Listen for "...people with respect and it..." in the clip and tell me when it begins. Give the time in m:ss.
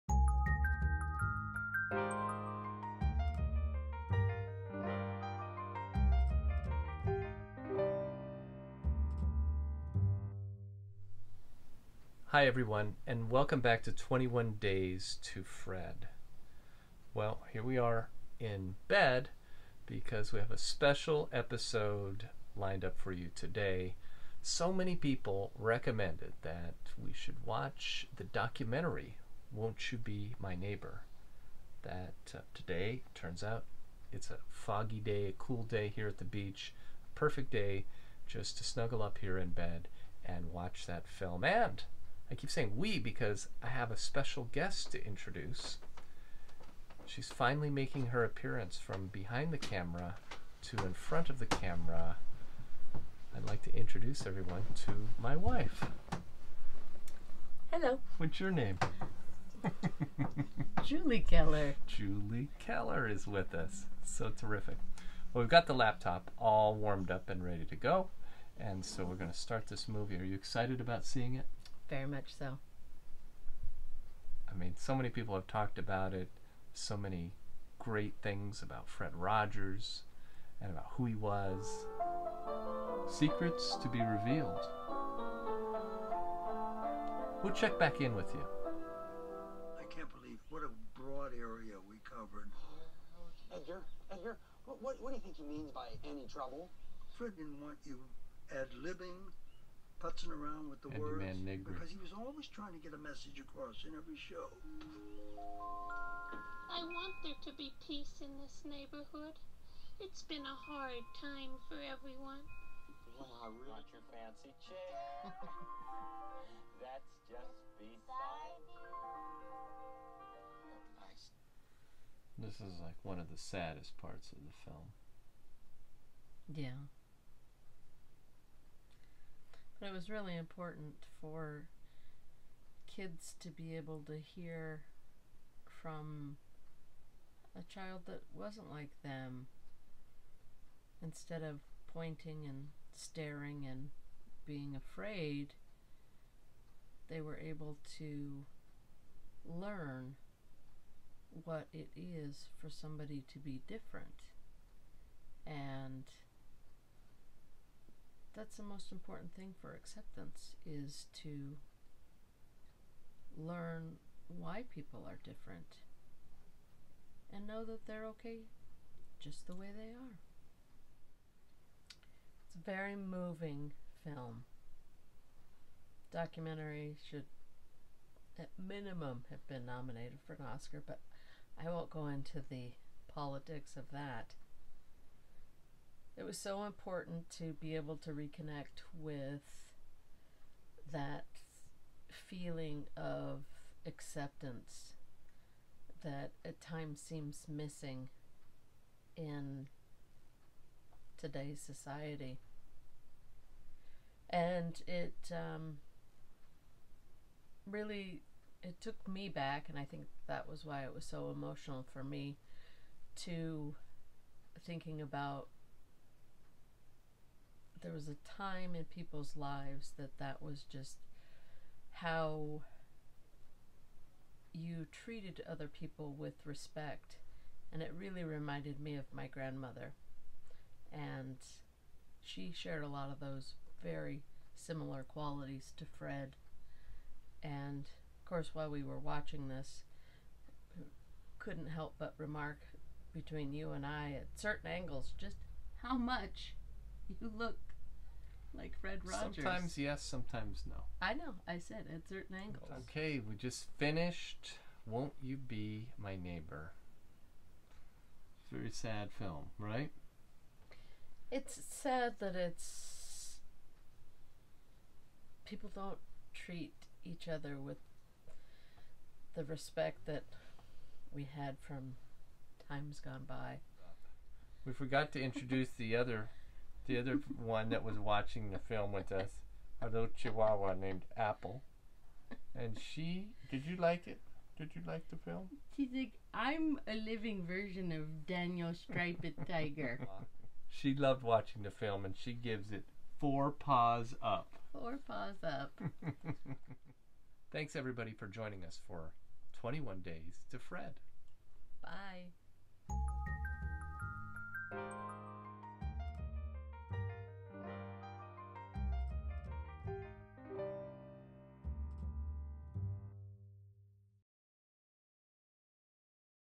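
3:45.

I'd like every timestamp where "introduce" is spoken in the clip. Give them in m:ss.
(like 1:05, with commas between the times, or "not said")
0:45, 0:53, 4:35.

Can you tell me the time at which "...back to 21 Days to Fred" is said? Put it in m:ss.
0:13.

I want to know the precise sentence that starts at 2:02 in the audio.
this is like one of the saddest parts of the film.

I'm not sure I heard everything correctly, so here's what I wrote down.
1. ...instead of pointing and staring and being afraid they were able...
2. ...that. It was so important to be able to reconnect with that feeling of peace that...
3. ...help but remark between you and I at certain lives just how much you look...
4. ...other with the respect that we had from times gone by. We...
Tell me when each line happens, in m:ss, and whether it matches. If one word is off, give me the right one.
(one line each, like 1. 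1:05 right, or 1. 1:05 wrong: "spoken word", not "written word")
1. 2:21 right
2. 3:03 wrong: "acceptance", not "peace"
3. 4:01 wrong: "angles", not "lives"
4. 4:27 right.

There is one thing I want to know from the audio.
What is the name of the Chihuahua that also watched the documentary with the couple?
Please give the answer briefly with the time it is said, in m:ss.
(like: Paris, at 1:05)
Apple, at 4:41.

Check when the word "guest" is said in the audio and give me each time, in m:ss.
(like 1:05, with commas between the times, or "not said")
0:44.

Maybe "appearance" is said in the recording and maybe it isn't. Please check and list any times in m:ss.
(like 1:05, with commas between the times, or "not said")
0:48.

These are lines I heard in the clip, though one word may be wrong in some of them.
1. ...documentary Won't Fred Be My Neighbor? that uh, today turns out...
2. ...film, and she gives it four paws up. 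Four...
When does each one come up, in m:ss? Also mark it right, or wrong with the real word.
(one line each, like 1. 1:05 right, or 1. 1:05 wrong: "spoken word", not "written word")
1. 0:28 wrong: "You", not "Fred"
2. 4:51 right.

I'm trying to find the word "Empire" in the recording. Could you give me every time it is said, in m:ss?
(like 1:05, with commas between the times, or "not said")
not said.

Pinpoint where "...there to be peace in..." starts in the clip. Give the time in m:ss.
1:47.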